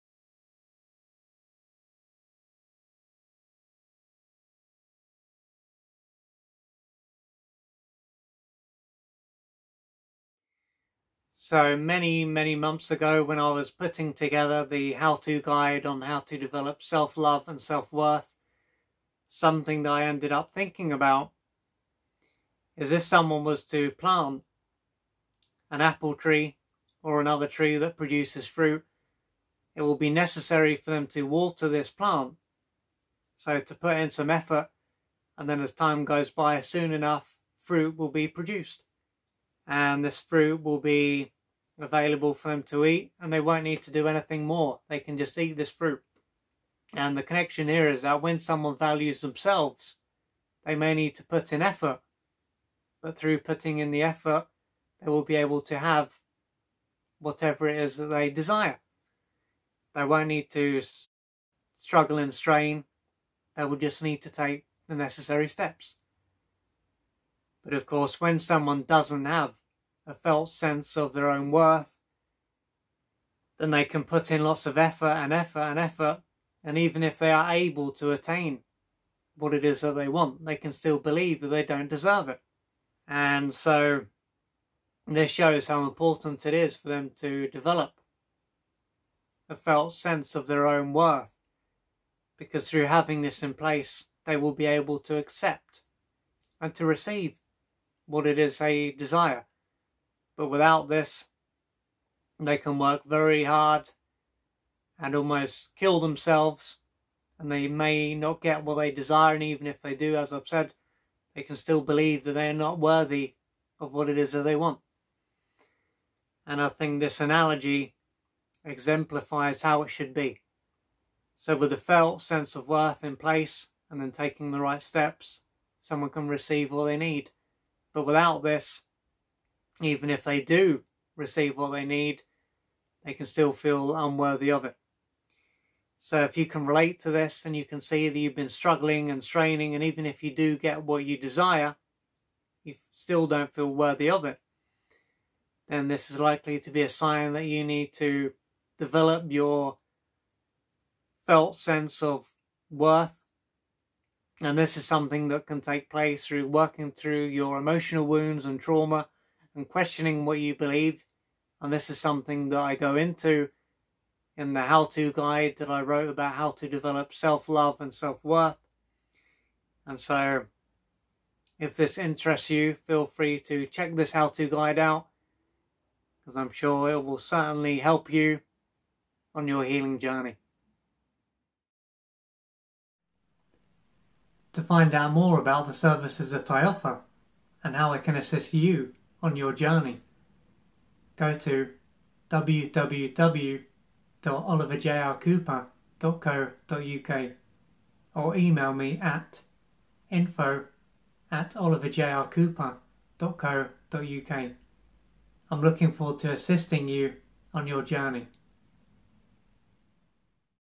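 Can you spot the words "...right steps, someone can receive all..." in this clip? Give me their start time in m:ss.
2:04.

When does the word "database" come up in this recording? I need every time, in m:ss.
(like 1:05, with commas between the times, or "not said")
not said.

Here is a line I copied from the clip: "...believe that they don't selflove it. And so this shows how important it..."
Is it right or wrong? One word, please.
wrong.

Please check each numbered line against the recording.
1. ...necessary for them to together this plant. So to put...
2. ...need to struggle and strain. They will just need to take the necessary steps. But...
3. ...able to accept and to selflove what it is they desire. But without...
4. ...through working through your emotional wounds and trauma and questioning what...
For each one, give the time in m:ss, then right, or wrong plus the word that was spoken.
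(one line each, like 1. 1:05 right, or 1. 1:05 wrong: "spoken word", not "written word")
1. 0:30 wrong: "water", not "together"
2. 1:00 right
3. 1:34 wrong: "receive", not "selflove"
4. 2:36 right.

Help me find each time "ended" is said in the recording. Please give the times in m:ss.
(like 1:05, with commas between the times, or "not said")
0:20.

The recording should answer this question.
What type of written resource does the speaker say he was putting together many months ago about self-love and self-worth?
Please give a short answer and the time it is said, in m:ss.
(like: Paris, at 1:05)
how-to guide, at 0:14.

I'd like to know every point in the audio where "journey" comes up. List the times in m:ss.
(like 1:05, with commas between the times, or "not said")
2:59, 3:09, 3:27.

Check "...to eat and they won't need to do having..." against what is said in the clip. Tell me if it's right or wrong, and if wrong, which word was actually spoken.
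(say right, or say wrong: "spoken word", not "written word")
wrong: "anything", not "having".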